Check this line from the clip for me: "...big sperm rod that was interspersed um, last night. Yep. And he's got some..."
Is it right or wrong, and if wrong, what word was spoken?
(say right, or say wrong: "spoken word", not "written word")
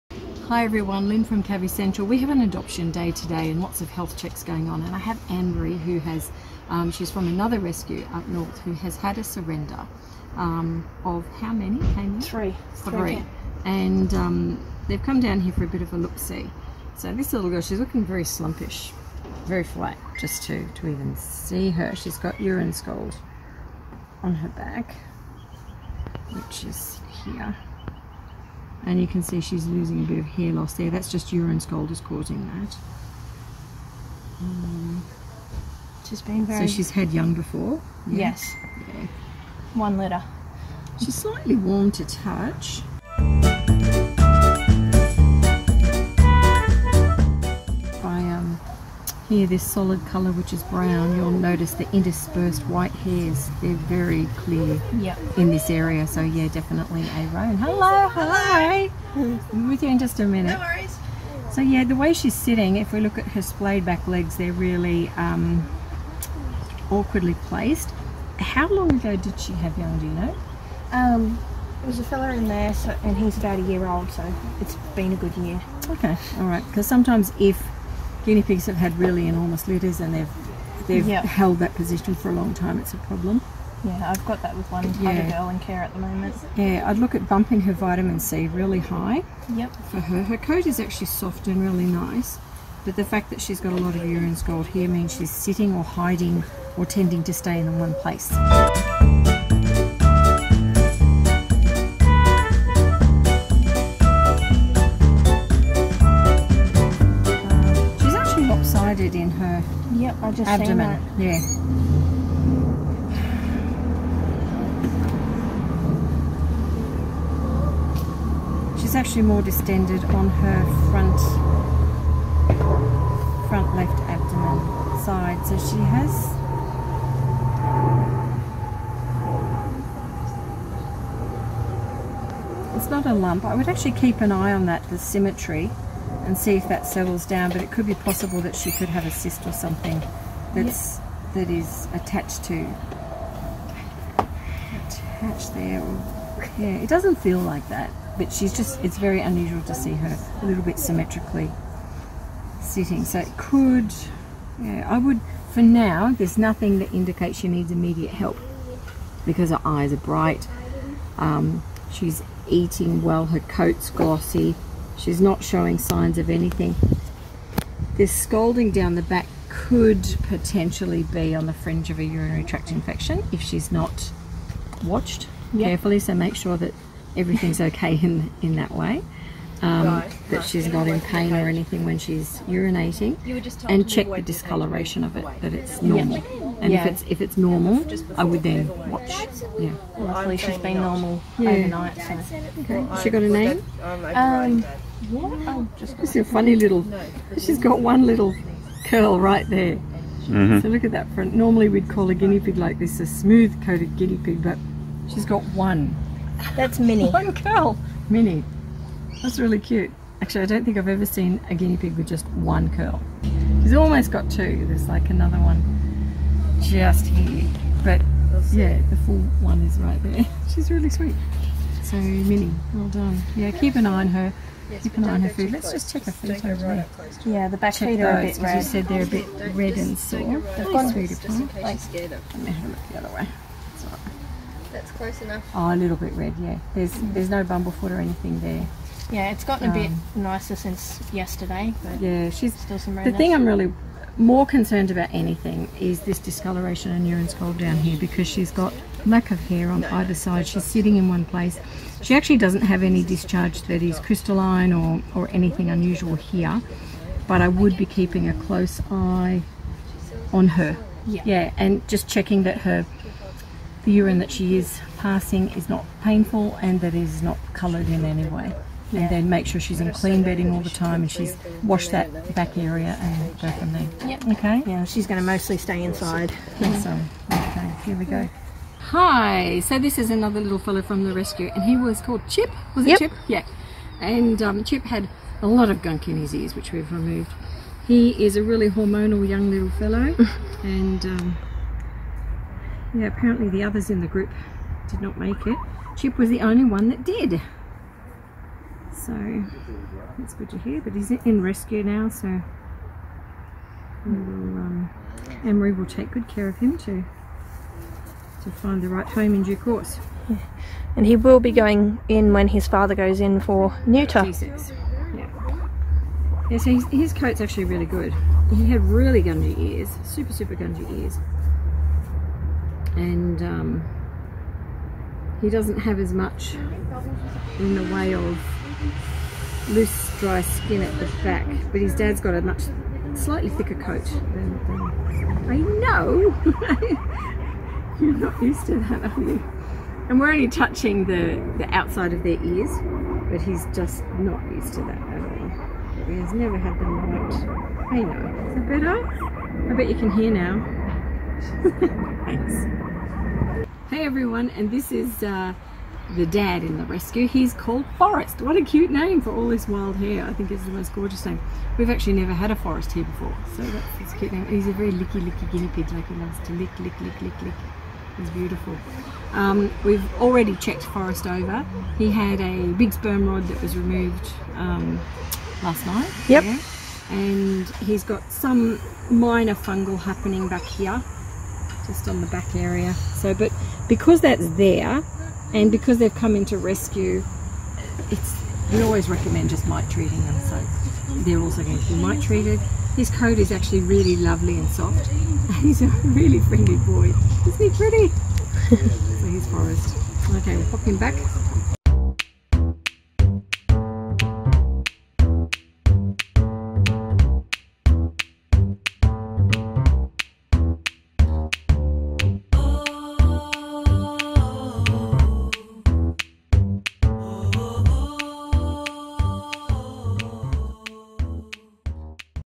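wrong: "removed", not "interspersed".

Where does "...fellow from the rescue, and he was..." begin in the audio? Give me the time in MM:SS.
04:40.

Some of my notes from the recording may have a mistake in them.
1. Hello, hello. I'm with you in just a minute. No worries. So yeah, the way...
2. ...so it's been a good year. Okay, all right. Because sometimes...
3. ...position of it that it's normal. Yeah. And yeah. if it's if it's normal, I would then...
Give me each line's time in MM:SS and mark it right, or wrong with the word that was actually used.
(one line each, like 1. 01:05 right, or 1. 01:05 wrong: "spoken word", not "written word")
1. 00:57 right
2. 01:14 right
3. 03:04 wrong: "discoloration", not "position".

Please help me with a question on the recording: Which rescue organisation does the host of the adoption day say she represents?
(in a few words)
Cavy Central.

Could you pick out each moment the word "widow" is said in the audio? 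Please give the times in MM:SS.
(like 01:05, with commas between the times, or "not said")
not said.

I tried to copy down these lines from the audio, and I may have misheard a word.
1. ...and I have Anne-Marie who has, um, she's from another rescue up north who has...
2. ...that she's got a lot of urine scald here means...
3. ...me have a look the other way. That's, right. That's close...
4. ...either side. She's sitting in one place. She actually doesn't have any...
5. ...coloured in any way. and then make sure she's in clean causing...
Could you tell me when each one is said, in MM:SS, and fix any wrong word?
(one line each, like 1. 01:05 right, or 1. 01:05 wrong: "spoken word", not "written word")
1. 00:04 right
2. 01:33 right
3. 03:52 right
4. 04:09 right
5. 04:27 wrong: "bedding", not "causing".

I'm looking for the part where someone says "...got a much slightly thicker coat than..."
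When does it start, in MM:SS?
05:32.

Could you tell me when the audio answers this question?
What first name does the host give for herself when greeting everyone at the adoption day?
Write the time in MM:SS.
00:01.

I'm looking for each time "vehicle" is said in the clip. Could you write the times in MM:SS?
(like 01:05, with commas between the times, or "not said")
not said.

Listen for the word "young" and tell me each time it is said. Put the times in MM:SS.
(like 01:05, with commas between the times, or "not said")
00:37, 01:09, 04:49.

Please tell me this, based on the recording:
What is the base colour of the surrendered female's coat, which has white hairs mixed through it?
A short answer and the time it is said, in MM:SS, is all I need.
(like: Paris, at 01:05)
Brown, at 00:50.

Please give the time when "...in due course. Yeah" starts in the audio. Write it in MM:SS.
05:09.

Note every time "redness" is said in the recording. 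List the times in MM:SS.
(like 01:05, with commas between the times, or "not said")
04:02.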